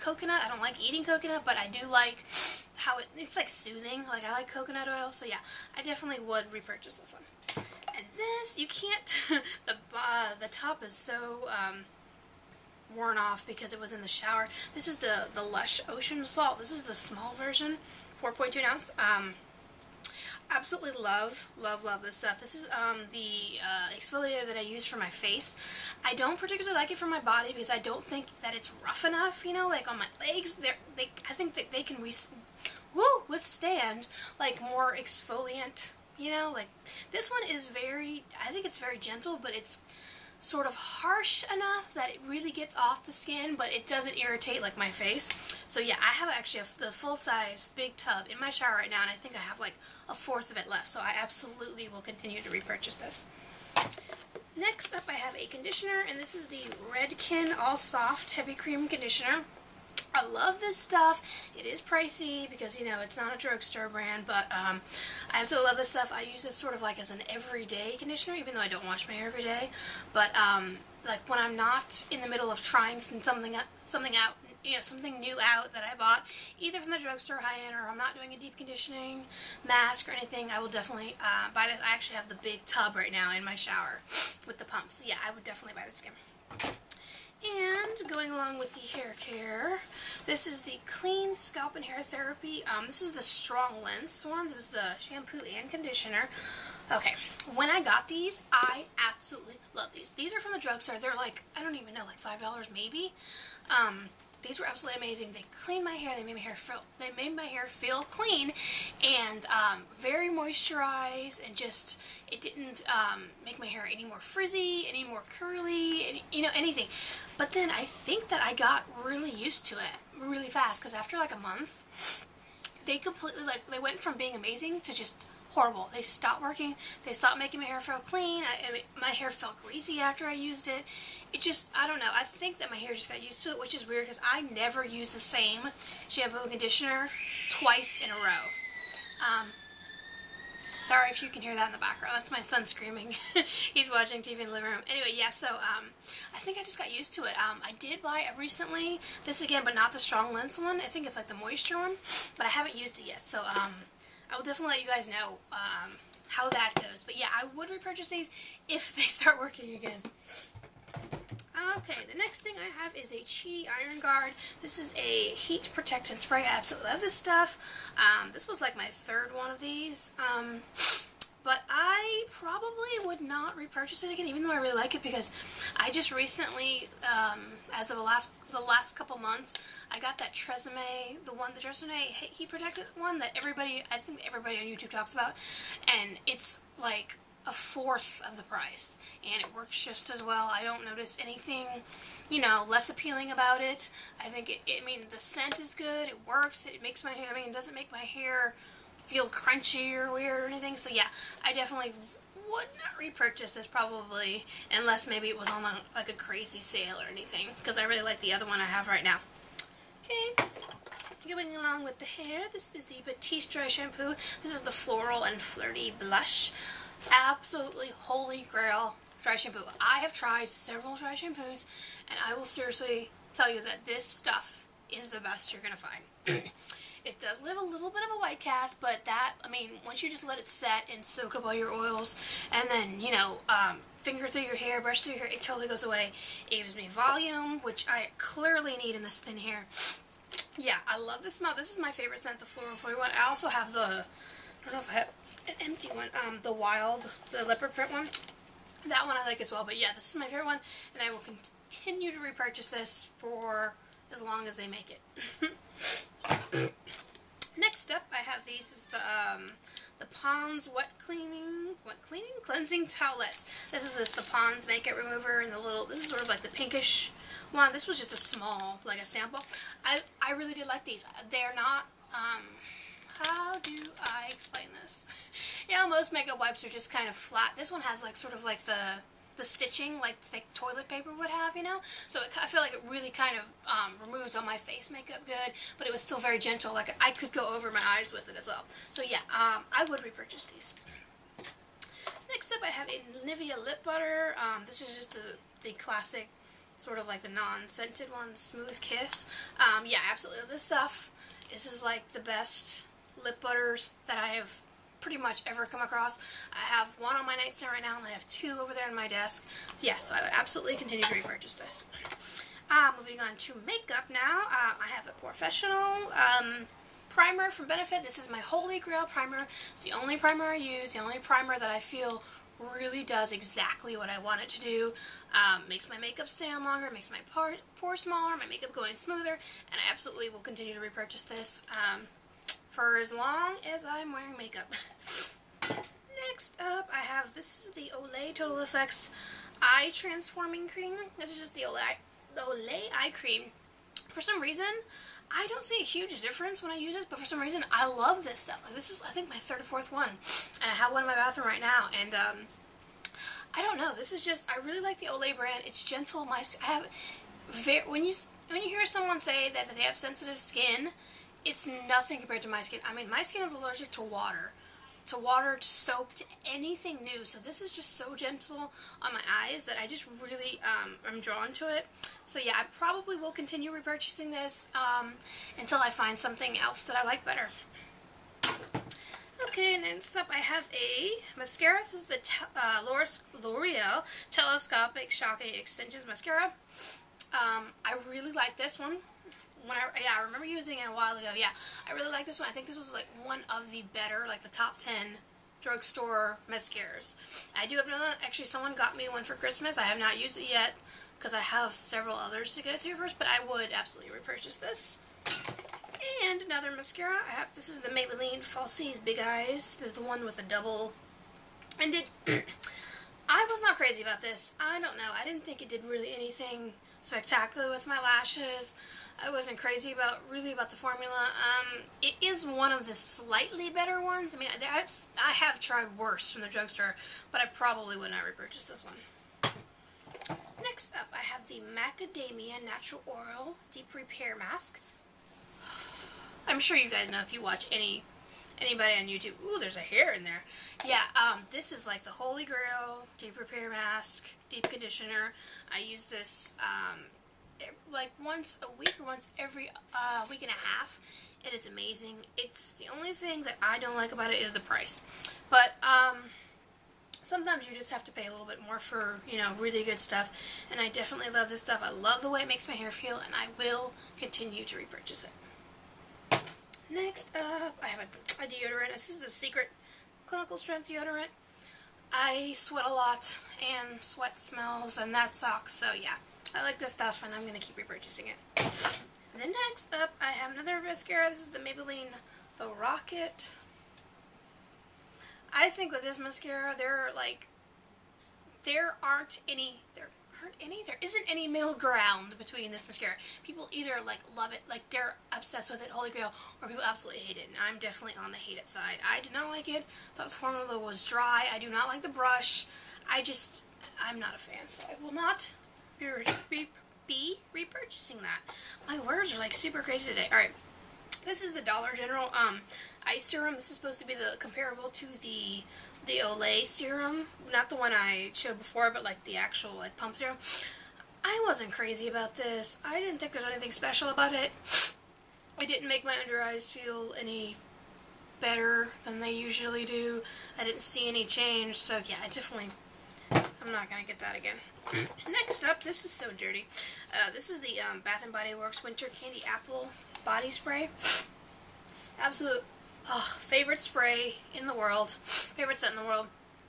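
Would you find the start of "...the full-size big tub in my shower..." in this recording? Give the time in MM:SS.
00:46.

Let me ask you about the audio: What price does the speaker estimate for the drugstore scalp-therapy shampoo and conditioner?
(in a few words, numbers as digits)
$5.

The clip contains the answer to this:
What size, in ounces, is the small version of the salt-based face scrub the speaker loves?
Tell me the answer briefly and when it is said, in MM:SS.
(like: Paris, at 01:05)
4.2 ounces, at 00:18.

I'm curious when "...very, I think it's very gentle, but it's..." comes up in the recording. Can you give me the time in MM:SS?
00:37.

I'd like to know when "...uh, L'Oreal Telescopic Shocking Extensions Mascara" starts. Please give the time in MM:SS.
06:22.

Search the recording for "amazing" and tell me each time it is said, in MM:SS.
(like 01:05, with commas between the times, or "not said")
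01:45, 02:04, 07:31.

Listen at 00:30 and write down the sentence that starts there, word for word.
They, are I think that they can Woo!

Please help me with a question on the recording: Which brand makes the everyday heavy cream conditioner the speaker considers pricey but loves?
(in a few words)
Redken.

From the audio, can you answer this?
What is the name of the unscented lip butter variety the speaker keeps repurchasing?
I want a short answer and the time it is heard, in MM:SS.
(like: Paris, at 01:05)
Smooth Kiss, at 04:58.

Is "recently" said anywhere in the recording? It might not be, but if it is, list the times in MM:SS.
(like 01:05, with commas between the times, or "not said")
02:28, 02:56.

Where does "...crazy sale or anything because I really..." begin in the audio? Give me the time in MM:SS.
03:26.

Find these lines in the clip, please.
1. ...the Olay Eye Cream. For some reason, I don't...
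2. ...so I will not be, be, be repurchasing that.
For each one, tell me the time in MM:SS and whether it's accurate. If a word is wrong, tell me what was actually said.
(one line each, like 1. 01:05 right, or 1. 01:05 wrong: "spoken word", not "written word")
1. 05:42 right
2. 08:24 right.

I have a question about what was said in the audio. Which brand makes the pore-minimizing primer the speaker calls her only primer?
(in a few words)
Benefit.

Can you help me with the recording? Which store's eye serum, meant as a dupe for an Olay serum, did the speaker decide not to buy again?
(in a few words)
Dollar General.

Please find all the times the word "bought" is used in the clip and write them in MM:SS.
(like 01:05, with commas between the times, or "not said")
01:15.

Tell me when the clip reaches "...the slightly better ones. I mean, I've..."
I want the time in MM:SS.
07:02.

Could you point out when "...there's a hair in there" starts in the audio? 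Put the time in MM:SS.
07:19.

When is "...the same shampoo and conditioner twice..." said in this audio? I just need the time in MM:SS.
02:15.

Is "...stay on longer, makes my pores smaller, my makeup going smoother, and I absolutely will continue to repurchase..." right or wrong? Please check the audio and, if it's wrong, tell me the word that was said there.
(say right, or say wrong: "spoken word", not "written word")
right.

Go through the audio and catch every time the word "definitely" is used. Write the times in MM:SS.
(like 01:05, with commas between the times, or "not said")
00:05, 01:20, 01:25, 02:34, 03:21, 07:40, 08:17, 08:52.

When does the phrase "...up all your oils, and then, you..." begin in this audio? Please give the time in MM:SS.
03:51.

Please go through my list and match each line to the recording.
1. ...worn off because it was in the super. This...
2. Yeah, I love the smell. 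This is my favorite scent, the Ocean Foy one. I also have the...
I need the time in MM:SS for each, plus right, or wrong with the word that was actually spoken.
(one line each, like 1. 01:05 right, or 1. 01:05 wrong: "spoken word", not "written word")
1. 00:12 wrong: "shower", not "super"
2. 04:00 wrong: "Floral", not "Ocean".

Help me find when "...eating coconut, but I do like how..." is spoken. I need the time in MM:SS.
00:00.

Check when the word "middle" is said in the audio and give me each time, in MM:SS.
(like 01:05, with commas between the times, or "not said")
01:12, 08:11.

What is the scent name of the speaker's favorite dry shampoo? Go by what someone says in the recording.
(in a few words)
Floral and Flirty Blush.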